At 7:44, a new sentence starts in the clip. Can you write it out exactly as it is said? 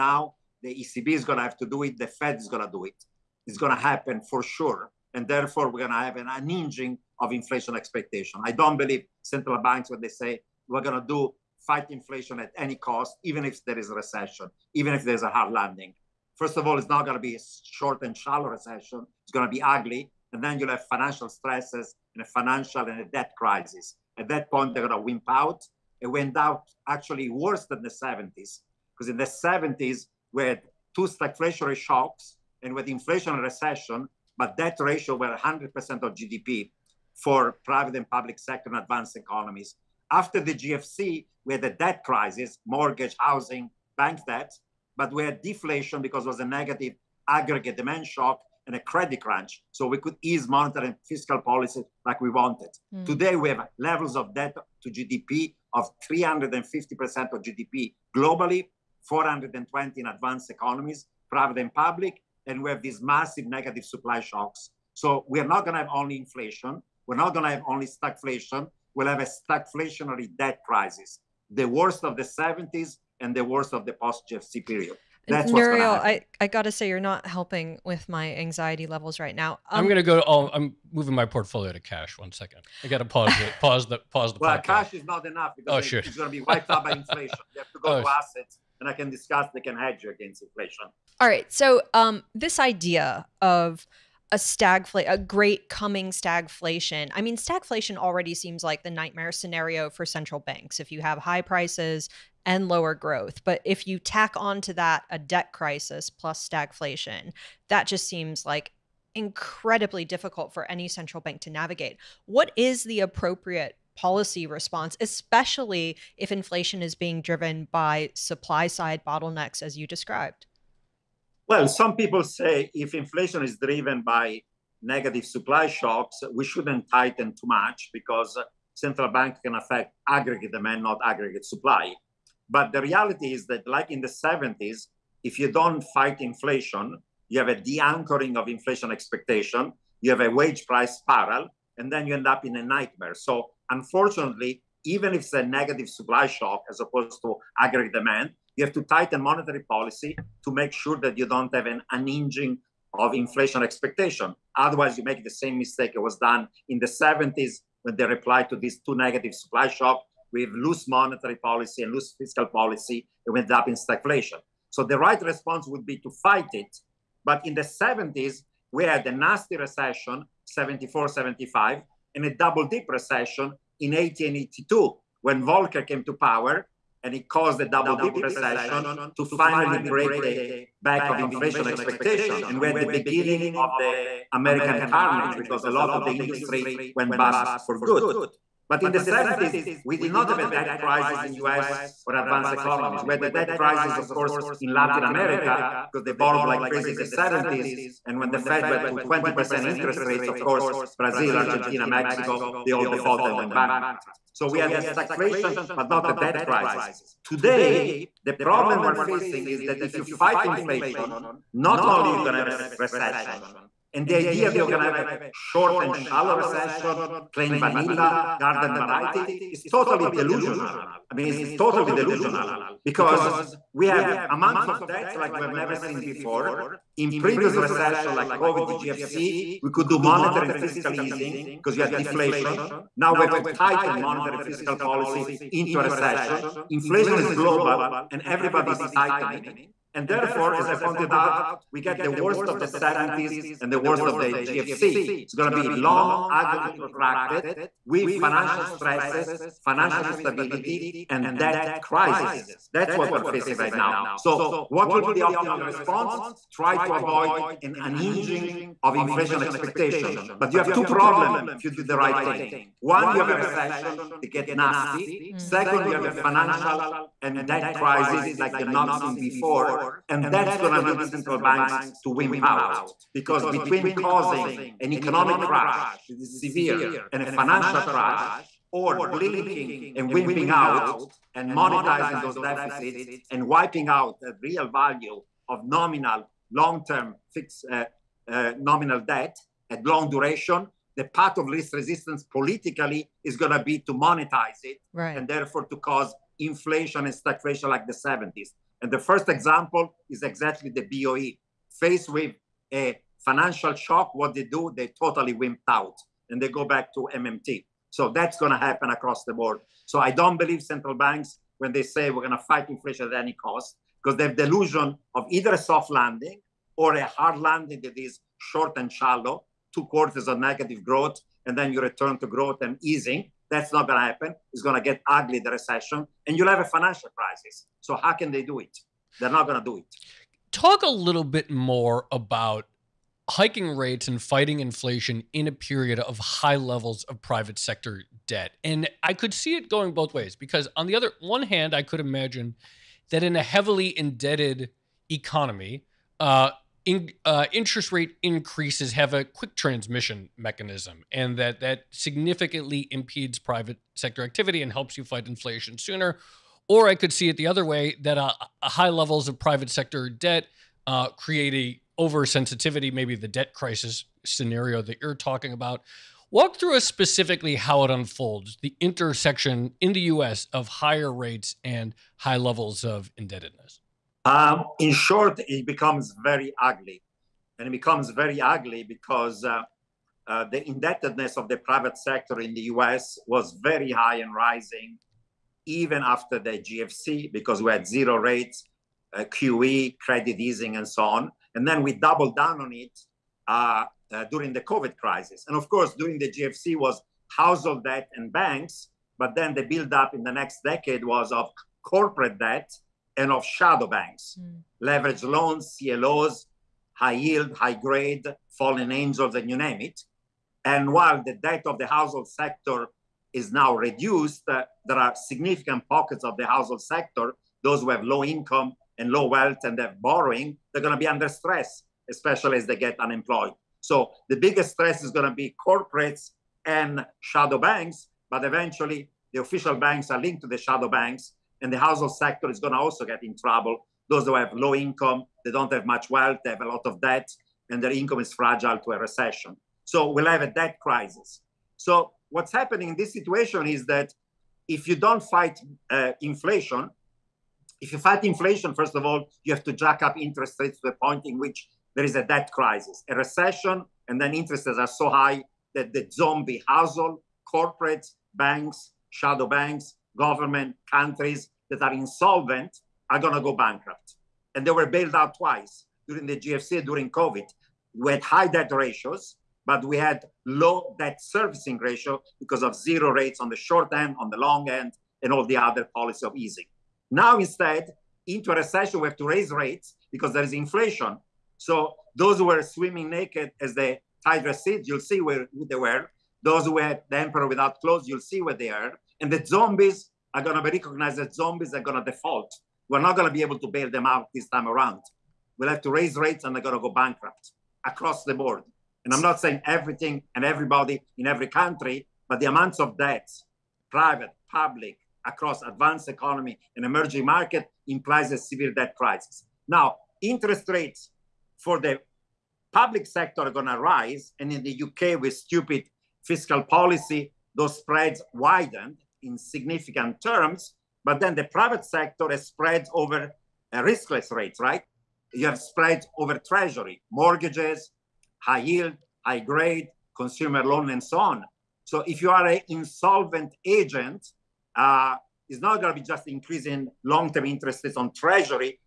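And they were bailed out twice during the GFC, during COVID.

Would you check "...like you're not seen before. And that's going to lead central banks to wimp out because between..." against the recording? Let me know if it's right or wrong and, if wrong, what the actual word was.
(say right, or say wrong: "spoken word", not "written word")
right.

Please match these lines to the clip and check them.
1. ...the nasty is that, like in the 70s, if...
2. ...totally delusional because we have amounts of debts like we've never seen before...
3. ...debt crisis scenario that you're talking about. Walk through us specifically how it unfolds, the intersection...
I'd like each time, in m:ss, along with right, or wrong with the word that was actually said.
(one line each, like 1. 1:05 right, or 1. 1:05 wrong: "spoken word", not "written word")
1. 2:12 wrong: "reality", not "nasty"
2. 3:41 right
3. 6:03 right.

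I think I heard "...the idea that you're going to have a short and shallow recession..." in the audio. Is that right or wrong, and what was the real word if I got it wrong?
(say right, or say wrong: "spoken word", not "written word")
right.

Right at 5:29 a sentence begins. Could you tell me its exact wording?
They're not going to do it.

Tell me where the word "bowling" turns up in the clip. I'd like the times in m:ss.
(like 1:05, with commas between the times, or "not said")
not said.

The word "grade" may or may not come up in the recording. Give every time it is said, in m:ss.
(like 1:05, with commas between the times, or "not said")
6:47, 8:49.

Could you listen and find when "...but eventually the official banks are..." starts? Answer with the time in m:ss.
7:08.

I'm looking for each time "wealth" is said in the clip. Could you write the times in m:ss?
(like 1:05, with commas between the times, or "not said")
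6:59, 7:16.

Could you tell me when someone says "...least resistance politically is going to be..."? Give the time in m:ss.
4:51.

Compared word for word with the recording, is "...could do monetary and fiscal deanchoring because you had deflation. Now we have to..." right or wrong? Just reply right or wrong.
wrong.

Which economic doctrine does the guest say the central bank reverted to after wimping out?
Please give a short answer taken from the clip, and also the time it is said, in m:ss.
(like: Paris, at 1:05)
MMT, at 5:07.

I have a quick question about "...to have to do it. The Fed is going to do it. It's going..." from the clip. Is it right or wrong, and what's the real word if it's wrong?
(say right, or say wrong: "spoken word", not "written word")
right.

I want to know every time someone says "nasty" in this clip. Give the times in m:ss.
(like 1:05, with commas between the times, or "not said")
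2:49, 4:24.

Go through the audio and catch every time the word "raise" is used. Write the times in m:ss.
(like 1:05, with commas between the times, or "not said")
7:59, 8:15.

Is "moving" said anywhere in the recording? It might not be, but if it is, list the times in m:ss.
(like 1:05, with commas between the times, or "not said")
1:20.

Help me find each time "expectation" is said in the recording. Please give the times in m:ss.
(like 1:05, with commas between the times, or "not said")
0:07, 2:18, 2:33, 3:01, 4:19.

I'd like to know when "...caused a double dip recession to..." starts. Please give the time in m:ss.
2:57.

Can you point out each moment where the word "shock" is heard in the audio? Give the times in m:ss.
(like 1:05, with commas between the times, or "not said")
0:31, 0:48, 1:04, 2:05, 2:26, 2:39, 5:03.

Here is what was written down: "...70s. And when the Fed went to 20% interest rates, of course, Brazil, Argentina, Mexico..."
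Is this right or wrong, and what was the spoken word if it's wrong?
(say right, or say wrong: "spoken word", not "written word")
right.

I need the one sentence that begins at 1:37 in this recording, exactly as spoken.
I mean, stagflation already seems like the nightmare scenario for central banks.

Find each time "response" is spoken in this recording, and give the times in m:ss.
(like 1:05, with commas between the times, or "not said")
1:54, 2:45, 4:15.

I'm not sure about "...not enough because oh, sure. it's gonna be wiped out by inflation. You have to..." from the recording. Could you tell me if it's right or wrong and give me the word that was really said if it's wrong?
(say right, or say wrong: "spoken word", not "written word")
right.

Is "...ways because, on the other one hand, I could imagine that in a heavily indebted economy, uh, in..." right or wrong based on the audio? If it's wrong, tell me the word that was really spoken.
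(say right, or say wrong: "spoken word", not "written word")
right.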